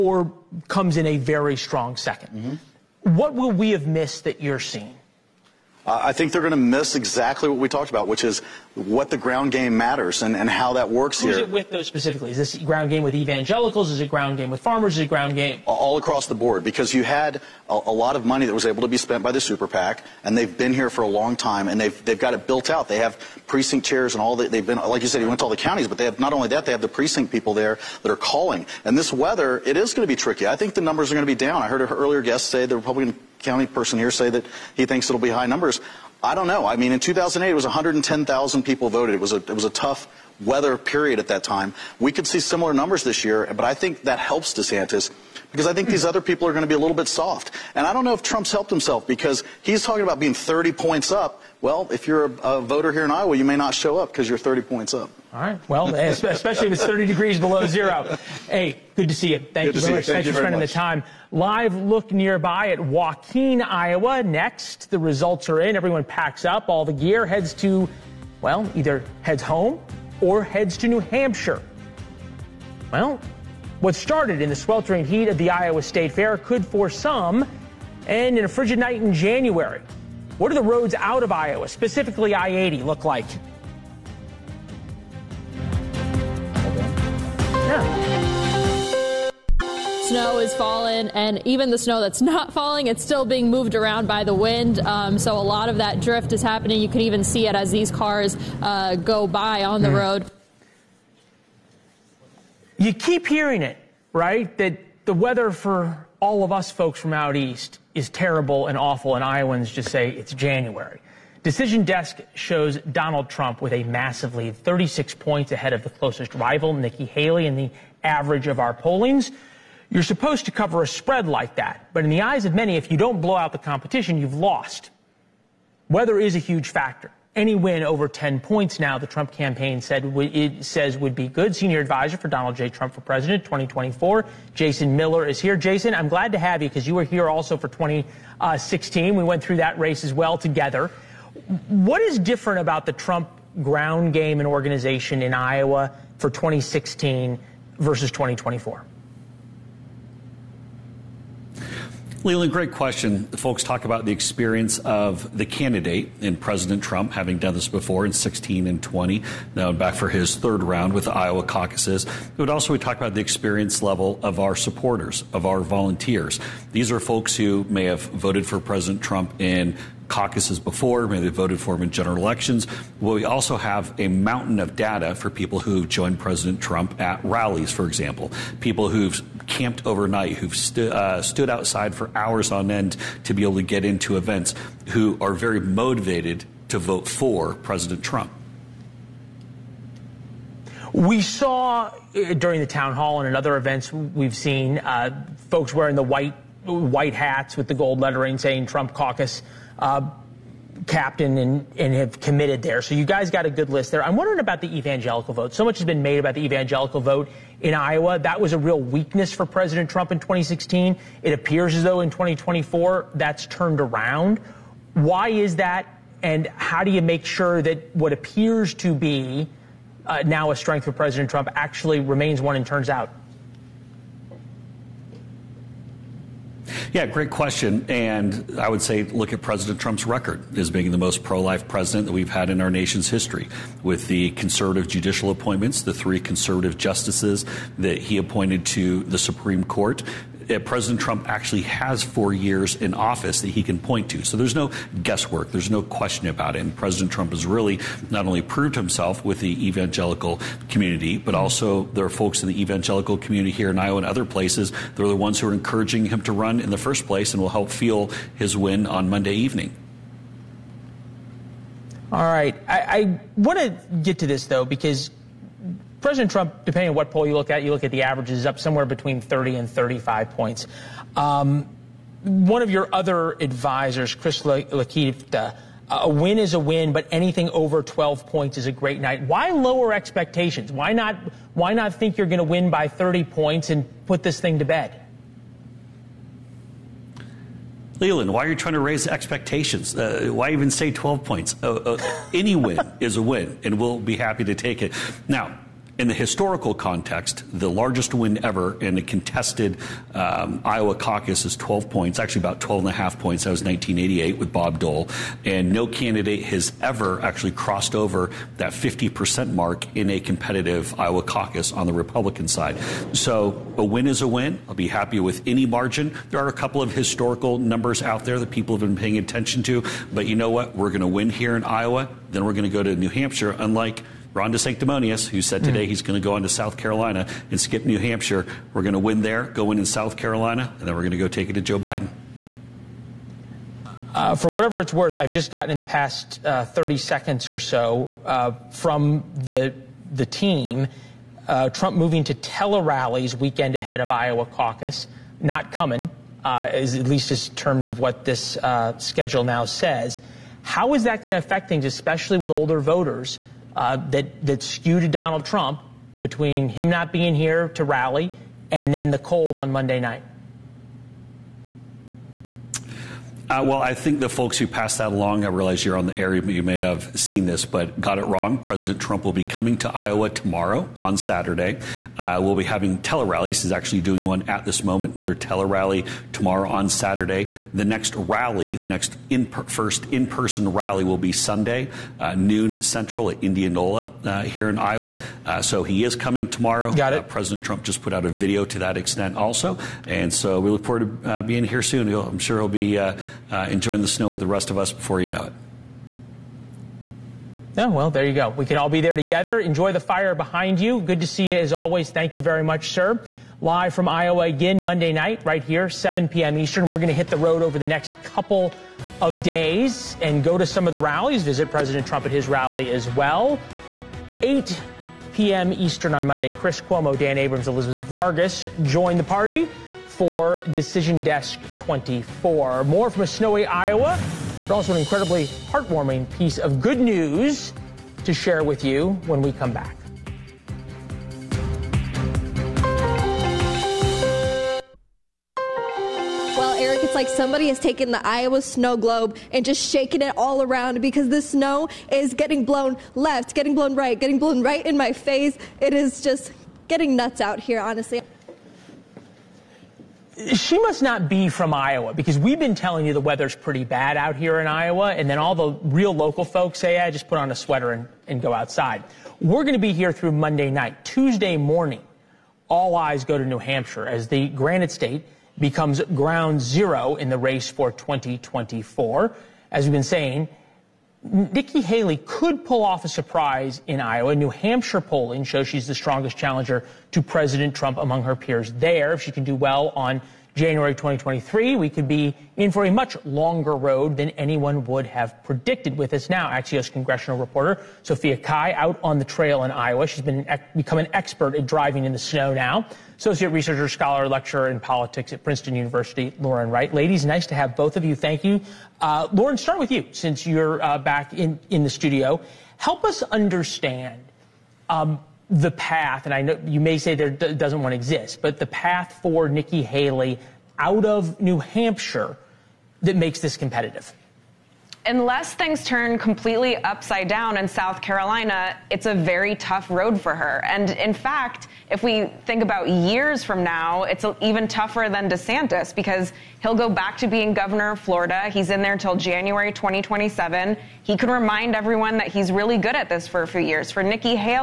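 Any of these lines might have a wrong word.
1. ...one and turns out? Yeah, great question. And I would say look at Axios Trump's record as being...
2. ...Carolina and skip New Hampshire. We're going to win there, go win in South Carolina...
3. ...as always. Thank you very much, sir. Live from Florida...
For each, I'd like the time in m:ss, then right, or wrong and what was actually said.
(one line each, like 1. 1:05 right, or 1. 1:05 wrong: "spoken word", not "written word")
1. 3:42 wrong: "President", not "Axios"
2. 5:26 right
3. 6:41 wrong: "Iowa", not "Florida".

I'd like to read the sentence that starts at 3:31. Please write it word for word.
It appears as though in 2024 that's turned around.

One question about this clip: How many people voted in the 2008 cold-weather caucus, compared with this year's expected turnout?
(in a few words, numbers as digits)
110,000.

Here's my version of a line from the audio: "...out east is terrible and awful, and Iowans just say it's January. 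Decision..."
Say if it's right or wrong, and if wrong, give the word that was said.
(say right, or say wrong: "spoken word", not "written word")
right.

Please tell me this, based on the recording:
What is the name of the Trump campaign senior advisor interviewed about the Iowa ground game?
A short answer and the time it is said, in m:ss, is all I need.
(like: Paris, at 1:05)
Jason Miller, at 2:14.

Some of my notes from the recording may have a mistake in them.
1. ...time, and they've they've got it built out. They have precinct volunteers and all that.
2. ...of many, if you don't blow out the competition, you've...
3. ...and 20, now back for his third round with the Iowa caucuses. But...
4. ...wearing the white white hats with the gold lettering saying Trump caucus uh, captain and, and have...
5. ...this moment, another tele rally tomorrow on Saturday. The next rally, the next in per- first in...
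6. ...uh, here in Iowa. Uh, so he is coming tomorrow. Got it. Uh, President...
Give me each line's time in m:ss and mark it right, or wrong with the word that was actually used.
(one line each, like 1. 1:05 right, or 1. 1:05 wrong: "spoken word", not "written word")
1. 0:21 wrong: "chairs", not "volunteers"
2. 2:02 right
3. 2:38 right
4. 3:15 right
5. 6:14 right
6. 6:24 right.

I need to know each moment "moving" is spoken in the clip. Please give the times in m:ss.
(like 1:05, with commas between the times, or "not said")
5:41.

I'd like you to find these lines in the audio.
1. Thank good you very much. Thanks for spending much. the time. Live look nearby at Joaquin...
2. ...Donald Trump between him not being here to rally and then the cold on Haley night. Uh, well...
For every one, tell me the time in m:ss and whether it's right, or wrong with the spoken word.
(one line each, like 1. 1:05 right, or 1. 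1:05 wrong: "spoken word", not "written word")
1. 0:59 right
2. 5:55 wrong: "Monday", not "Haley".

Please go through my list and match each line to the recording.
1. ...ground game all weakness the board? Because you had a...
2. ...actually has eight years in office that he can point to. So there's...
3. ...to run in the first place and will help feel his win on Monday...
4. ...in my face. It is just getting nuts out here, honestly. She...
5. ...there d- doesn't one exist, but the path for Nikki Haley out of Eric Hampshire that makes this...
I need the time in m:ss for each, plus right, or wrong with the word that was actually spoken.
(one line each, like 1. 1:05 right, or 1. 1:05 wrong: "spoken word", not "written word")
1. 0:15 wrong: "across", not "weakness"
2. 4:01 wrong: "four", not "eight"
3. 4:16 right
4. 7:24 right
5. 8:27 wrong: "New", not "Eric".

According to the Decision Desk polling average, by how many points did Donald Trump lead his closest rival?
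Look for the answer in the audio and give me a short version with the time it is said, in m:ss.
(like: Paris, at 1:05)
36 points, at 1:54.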